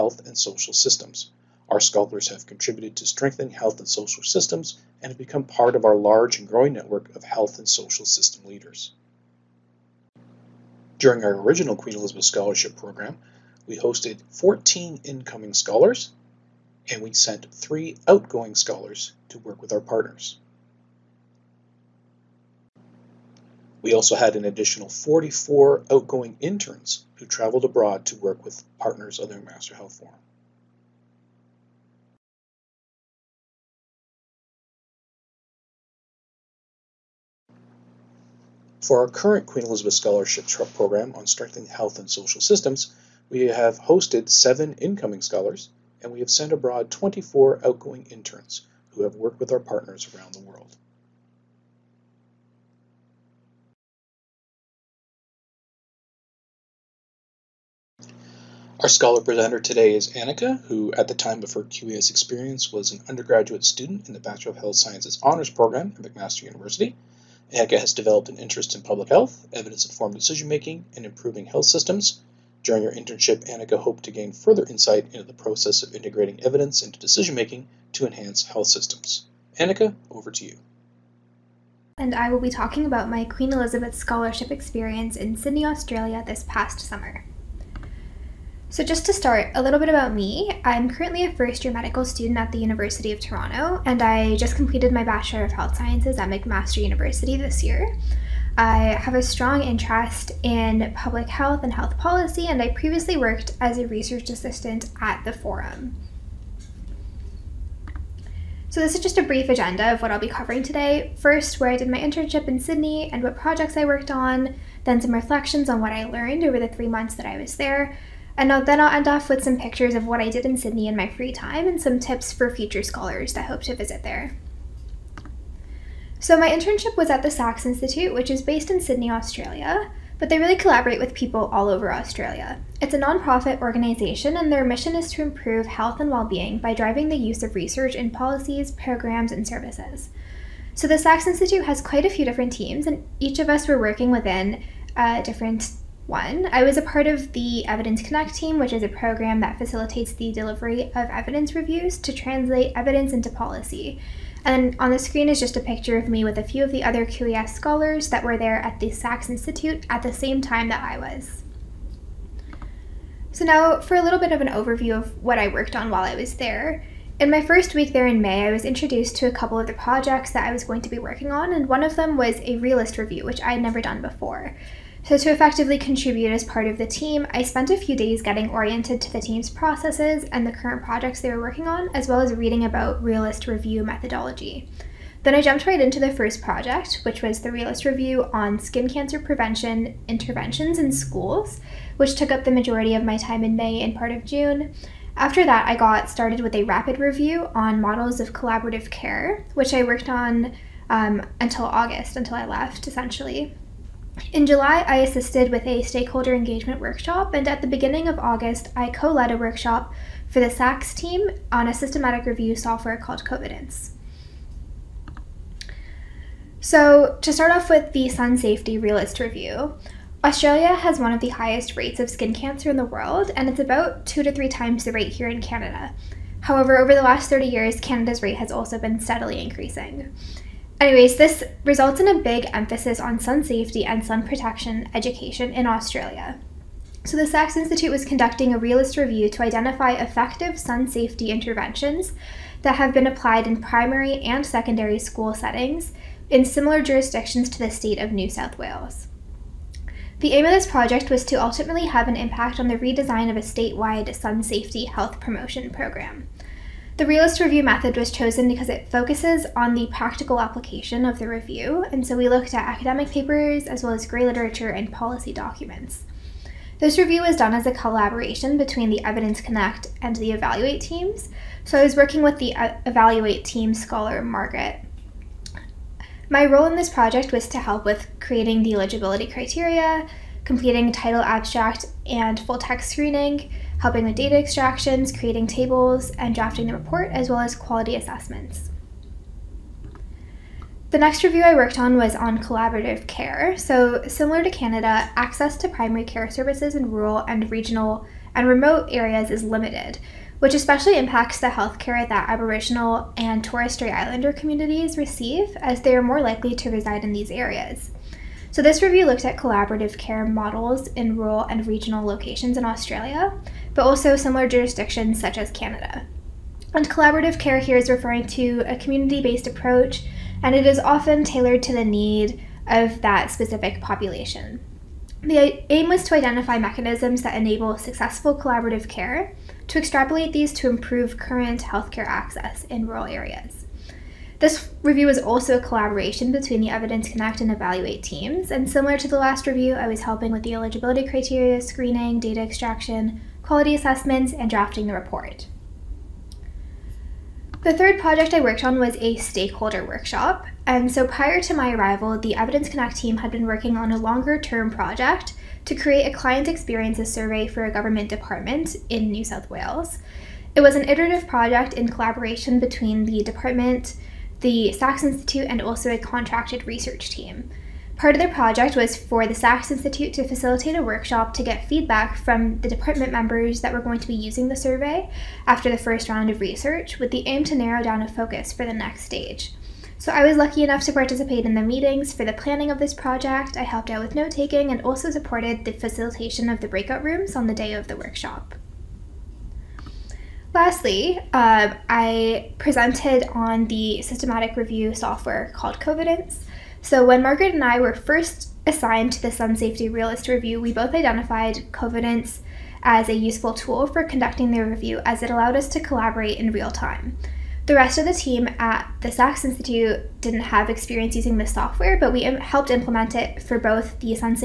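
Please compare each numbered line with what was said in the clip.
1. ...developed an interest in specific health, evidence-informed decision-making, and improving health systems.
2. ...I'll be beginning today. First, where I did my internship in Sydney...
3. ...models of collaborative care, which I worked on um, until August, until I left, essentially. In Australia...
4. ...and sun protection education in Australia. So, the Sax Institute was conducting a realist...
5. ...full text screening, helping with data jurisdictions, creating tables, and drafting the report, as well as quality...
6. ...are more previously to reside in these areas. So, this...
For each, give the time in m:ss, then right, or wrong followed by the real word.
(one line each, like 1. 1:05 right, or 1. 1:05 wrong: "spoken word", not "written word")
1. 1:07 wrong: "public", not "specific"
2. 1:50 wrong: "covering", not "beginning"
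3. 3:17 wrong: "July", not "Australia"
4. 3:53 right
5. 4:42 wrong: "extractions", not "jurisdictions"
6. 5:05 wrong: "likely", not "previously".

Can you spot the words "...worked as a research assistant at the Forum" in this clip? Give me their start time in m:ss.
1:43.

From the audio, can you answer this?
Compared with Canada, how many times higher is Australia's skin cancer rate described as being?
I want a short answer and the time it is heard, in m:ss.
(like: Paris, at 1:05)
2 to 3 times, at 3:44.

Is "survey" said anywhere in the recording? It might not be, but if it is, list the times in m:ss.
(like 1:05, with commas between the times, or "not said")
5:57, 6:14.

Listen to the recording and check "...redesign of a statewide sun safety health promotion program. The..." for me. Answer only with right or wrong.
right.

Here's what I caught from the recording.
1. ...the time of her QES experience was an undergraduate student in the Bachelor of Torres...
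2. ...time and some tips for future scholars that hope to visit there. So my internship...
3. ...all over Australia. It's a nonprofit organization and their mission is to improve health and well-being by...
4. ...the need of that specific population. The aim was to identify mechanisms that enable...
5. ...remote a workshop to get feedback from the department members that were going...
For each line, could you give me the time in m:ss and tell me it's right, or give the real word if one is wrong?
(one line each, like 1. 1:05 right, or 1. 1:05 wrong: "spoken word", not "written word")
1. 1:01 wrong: "Health", not "Torres"
2. 2:01 right
3. 2:11 right
4. 5:21 right
5. 6:10 wrong: "facilitate", not "remote".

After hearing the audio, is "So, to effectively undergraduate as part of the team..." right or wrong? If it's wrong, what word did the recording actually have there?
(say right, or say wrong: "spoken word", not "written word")
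wrong: "contribute", not "undergraduate".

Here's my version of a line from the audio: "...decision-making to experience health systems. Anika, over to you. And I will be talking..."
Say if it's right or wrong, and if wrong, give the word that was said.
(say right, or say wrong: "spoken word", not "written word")
wrong: "enhance", not "experience".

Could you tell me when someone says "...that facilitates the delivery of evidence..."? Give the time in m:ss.
2:29.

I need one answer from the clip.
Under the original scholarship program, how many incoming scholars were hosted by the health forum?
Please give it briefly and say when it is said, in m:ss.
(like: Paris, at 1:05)
14, at 0:14.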